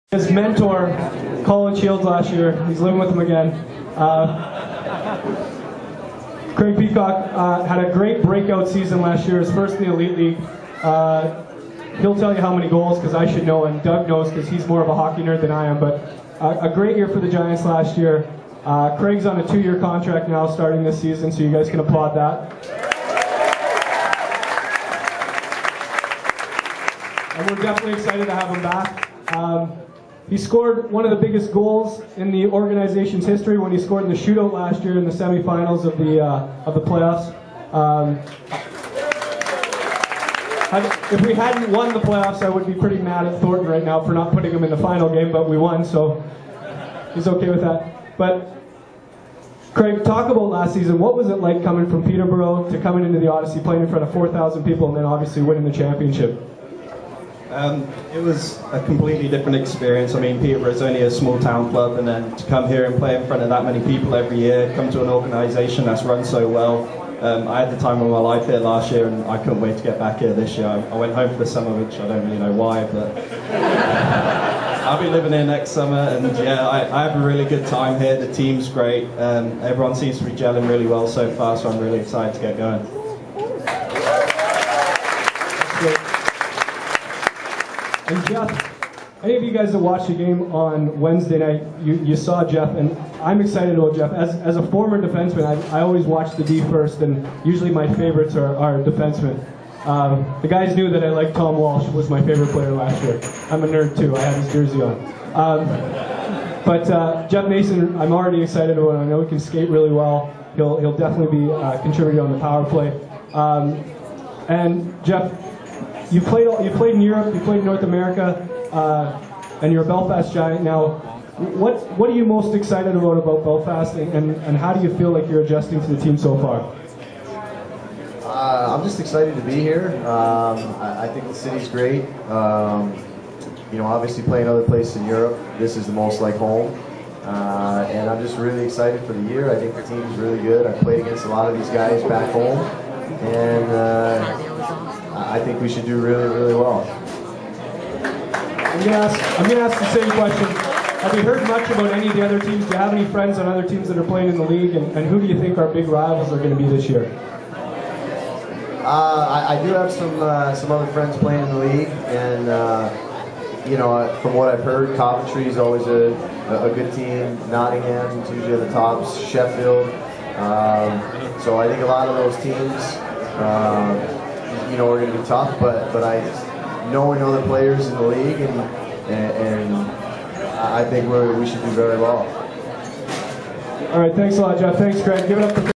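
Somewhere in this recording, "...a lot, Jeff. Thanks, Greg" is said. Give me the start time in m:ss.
3:04.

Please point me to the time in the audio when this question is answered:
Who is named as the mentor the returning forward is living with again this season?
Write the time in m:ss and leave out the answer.
0:01.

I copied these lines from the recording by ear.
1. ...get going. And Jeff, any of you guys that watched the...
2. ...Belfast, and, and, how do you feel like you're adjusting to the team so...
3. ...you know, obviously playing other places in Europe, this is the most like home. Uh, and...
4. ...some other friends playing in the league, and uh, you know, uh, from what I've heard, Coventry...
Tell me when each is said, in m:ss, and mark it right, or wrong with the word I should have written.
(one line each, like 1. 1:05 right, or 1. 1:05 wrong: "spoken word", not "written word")
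1. 1:22 right
2. 2:03 right
3. 2:13 right
4. 2:40 right.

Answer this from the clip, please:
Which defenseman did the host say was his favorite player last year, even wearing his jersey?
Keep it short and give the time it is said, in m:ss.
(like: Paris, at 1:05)
Tom Walsh, at 1:41.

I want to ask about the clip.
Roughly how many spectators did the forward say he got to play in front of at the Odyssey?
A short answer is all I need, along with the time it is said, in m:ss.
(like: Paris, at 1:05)
4,000, at 0:54.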